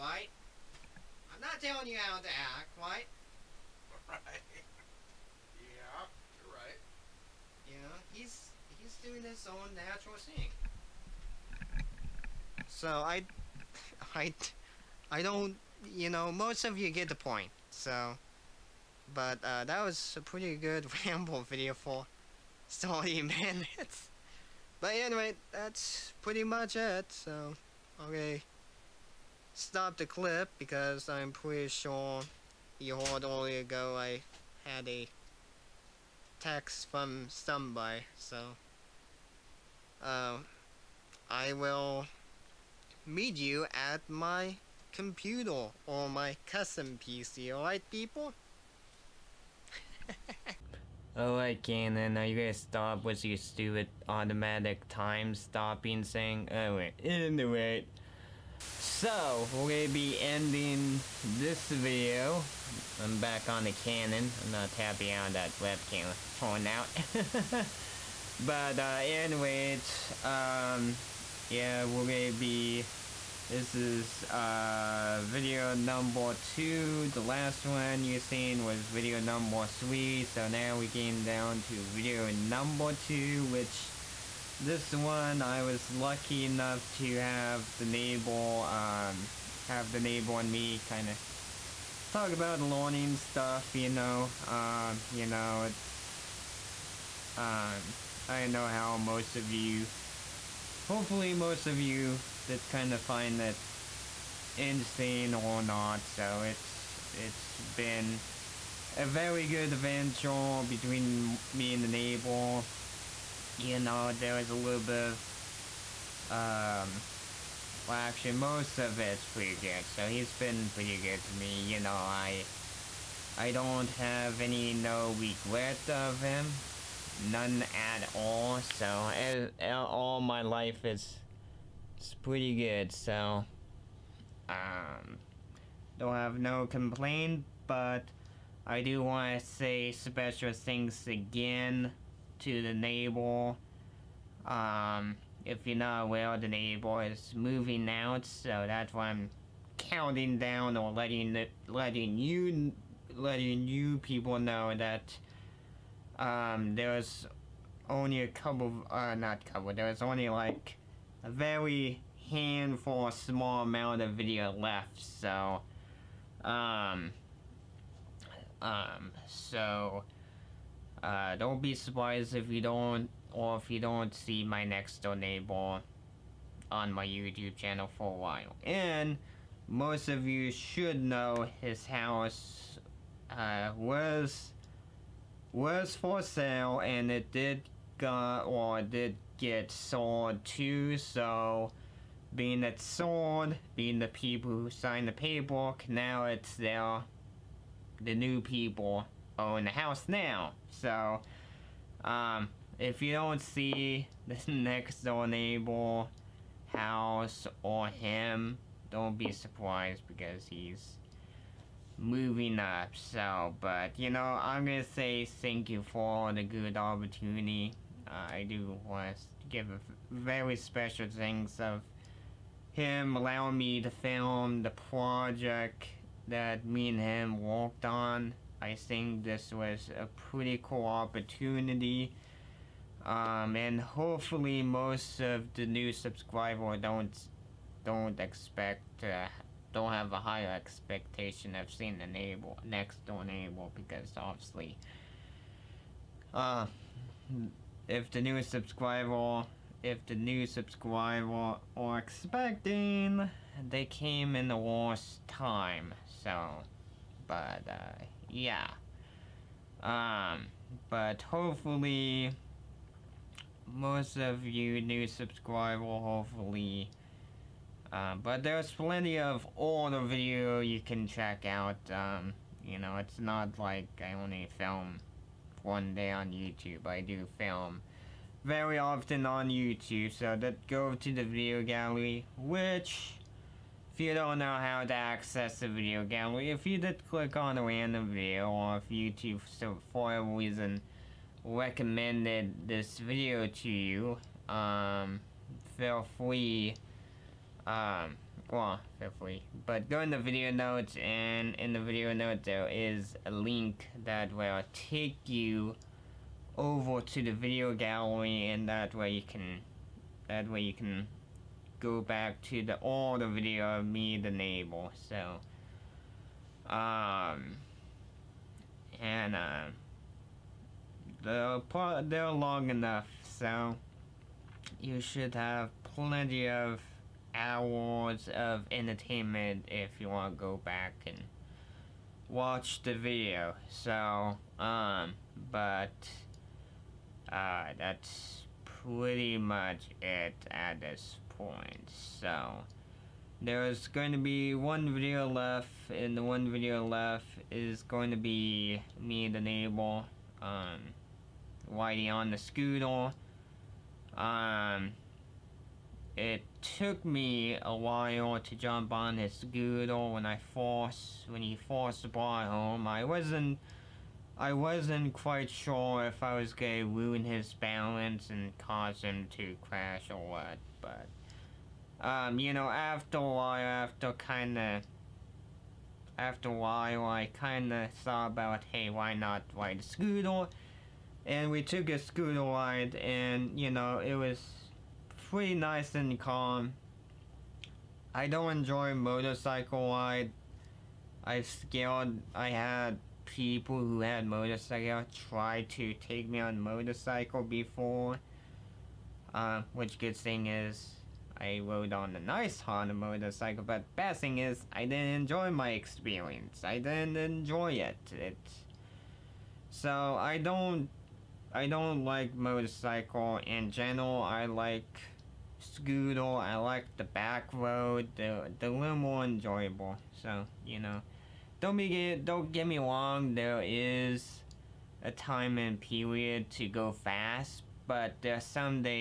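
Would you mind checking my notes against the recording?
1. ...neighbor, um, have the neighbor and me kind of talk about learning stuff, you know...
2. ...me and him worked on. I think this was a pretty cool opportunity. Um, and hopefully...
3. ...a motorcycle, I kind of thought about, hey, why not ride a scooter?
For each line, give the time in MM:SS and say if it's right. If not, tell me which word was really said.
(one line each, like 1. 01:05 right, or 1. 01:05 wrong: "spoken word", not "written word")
1. 01:27 right
2. 03:46 right
3. 06:16 wrong: "while", not "motorcycle".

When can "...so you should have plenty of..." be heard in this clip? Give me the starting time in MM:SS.
05:23.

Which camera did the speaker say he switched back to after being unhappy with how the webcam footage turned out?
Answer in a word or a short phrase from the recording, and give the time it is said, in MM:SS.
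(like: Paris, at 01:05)
Canon, at 01:03.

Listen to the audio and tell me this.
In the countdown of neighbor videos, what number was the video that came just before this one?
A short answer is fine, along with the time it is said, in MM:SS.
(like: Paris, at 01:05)
3, at 01:19.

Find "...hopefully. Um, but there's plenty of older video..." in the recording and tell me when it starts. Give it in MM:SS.
04:26.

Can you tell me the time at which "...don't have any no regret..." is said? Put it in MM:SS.
02:03.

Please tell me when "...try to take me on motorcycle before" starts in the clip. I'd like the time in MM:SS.
06:35.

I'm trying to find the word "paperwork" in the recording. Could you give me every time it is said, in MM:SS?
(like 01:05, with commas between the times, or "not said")
03:15.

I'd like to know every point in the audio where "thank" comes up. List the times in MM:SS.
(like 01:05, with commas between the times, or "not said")
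03:35, 03:41.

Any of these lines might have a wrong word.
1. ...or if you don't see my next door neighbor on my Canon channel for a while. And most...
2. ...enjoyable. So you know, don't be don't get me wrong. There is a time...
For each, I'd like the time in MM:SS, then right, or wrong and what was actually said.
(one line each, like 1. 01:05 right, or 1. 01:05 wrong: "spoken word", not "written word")
1. 02:53 wrong: "YouTube", not "Canon"
2. 06:59 right.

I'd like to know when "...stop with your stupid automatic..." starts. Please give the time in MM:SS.
00:52.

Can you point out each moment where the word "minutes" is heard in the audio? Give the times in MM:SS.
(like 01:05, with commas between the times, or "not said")
00:23.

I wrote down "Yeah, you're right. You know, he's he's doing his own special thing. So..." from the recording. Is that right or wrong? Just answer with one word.
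wrong.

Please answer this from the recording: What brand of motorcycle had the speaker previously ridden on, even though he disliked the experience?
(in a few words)
Honda.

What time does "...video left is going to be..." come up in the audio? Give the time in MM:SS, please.
05:46.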